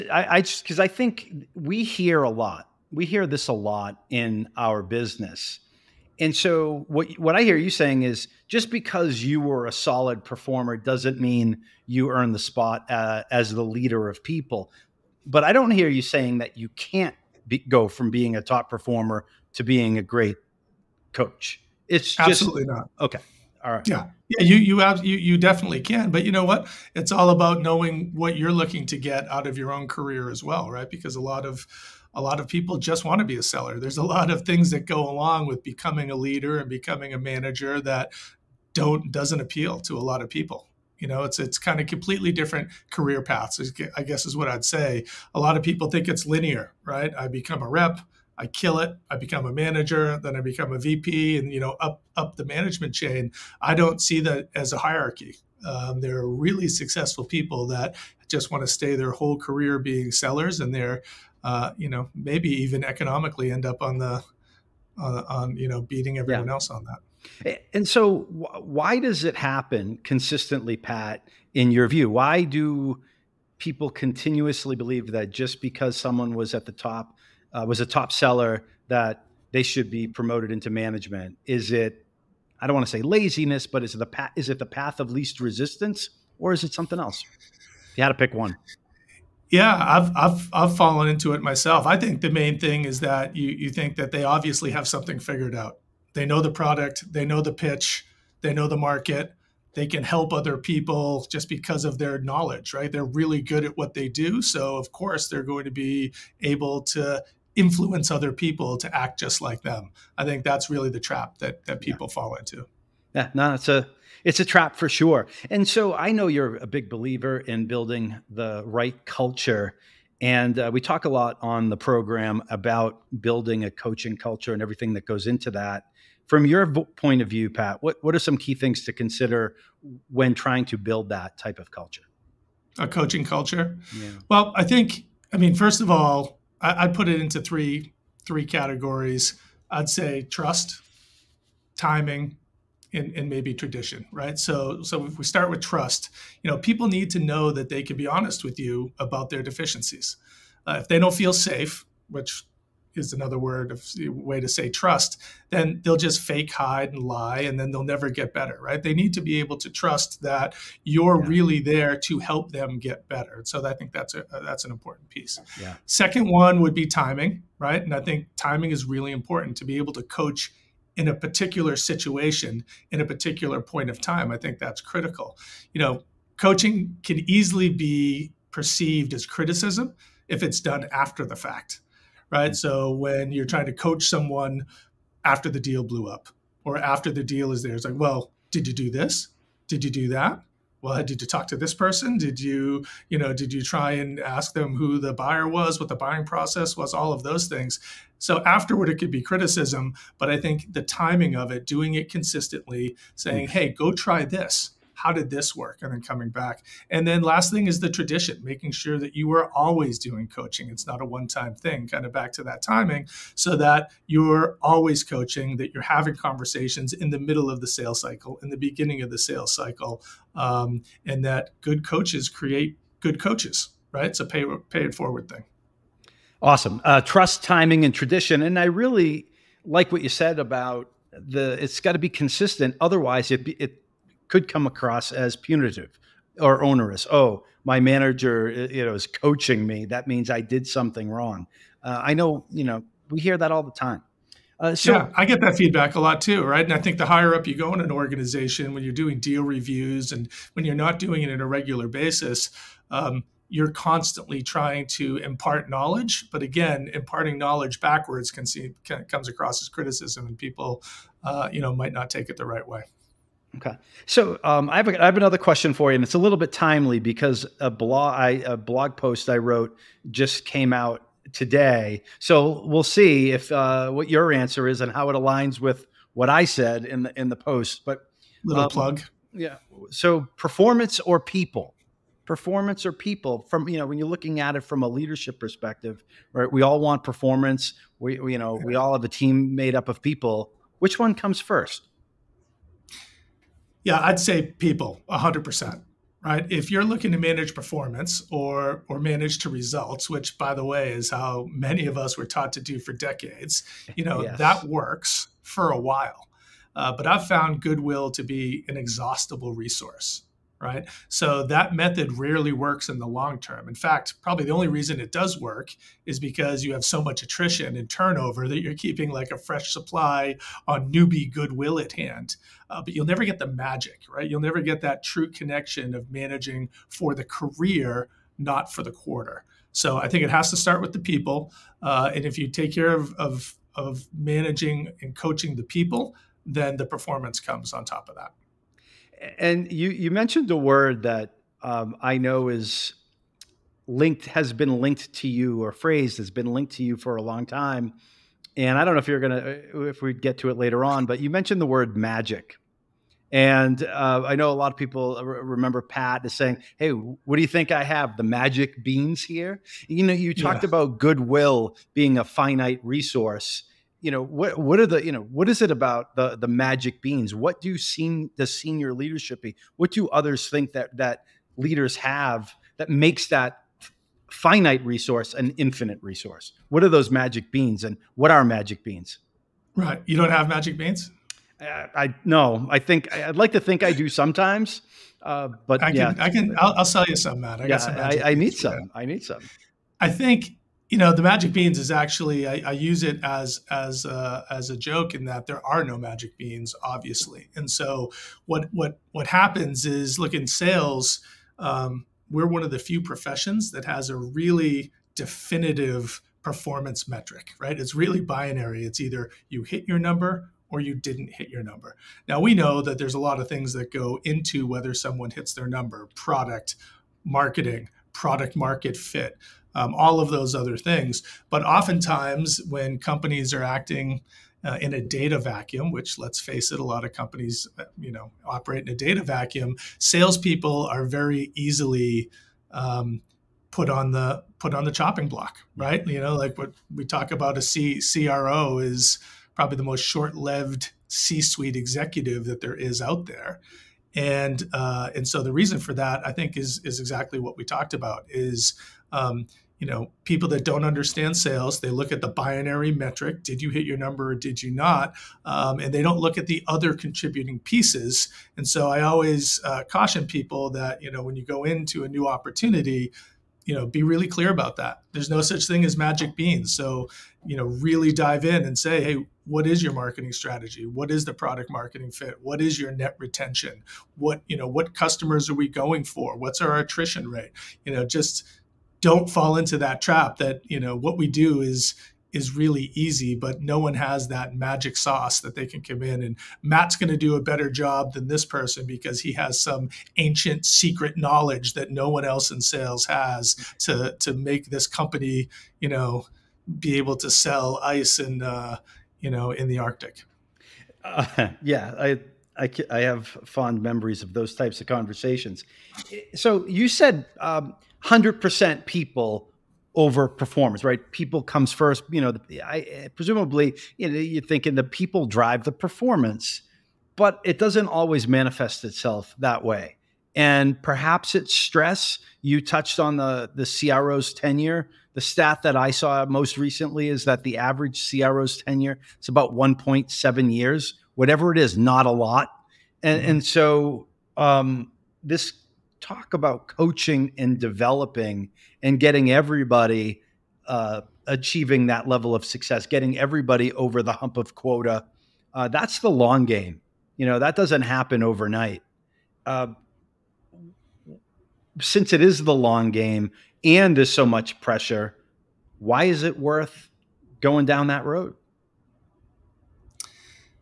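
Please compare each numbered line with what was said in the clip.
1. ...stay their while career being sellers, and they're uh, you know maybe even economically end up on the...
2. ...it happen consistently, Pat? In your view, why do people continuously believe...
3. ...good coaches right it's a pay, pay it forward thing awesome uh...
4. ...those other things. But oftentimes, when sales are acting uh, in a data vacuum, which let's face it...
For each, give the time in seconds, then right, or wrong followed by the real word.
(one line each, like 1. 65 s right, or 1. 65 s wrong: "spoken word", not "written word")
1. 58 s wrong: "whole", not "while"
2. 69 s right
3. 222 s right
4. 420 s wrong: "companies", not "sales".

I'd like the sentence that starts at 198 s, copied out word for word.
So afterward, it could be criticism, but I think the timing of it, doing it consistently, saying, mm-hmm.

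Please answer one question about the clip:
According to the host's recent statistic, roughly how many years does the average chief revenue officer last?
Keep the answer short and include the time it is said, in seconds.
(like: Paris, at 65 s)
1.7 years, at 529 s.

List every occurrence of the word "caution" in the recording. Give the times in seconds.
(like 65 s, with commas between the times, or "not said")
459 s.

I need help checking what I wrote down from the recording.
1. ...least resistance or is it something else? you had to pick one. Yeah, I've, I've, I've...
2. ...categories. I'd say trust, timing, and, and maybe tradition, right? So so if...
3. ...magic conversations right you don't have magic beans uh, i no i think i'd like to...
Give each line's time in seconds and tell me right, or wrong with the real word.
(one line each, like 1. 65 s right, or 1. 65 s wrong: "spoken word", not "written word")
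1. 85 s right
2. 138 s right
3. 378 s wrong: "beans", not "conversations".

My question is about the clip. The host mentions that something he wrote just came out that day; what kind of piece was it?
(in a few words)
Blog post.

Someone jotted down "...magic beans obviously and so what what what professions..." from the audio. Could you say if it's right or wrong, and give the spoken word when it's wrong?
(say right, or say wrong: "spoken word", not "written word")
wrong: "happens", not "professions".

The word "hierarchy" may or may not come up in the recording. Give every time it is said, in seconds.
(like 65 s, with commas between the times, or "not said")
54 s.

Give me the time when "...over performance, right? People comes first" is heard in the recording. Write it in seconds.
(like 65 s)
509 s.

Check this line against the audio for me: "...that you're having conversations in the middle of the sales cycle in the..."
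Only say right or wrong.
right.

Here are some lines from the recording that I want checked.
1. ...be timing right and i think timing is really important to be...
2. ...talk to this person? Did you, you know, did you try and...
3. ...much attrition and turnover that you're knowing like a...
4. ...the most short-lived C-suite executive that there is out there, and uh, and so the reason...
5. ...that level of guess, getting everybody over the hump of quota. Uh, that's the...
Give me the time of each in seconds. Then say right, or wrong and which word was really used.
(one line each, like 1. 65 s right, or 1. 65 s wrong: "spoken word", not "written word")
1. 166 s right
2. 191 s right
3. 317 s wrong: "keeping", not "knowing"
4. 439 s right
5. 541 s wrong: "success", not "guess".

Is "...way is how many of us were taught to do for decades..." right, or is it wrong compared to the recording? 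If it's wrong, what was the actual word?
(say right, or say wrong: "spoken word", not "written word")
right.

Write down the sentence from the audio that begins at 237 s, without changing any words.
Oh, my manager, uh, you know, is coaching me.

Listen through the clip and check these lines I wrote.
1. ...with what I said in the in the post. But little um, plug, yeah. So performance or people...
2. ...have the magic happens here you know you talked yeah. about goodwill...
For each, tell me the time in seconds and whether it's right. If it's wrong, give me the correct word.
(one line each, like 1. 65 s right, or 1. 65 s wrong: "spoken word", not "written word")
1. 275 s right
2. 357 s wrong: "beans", not "happens".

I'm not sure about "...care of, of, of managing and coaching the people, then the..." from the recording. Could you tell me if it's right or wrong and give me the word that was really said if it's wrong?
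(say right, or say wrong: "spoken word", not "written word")
right.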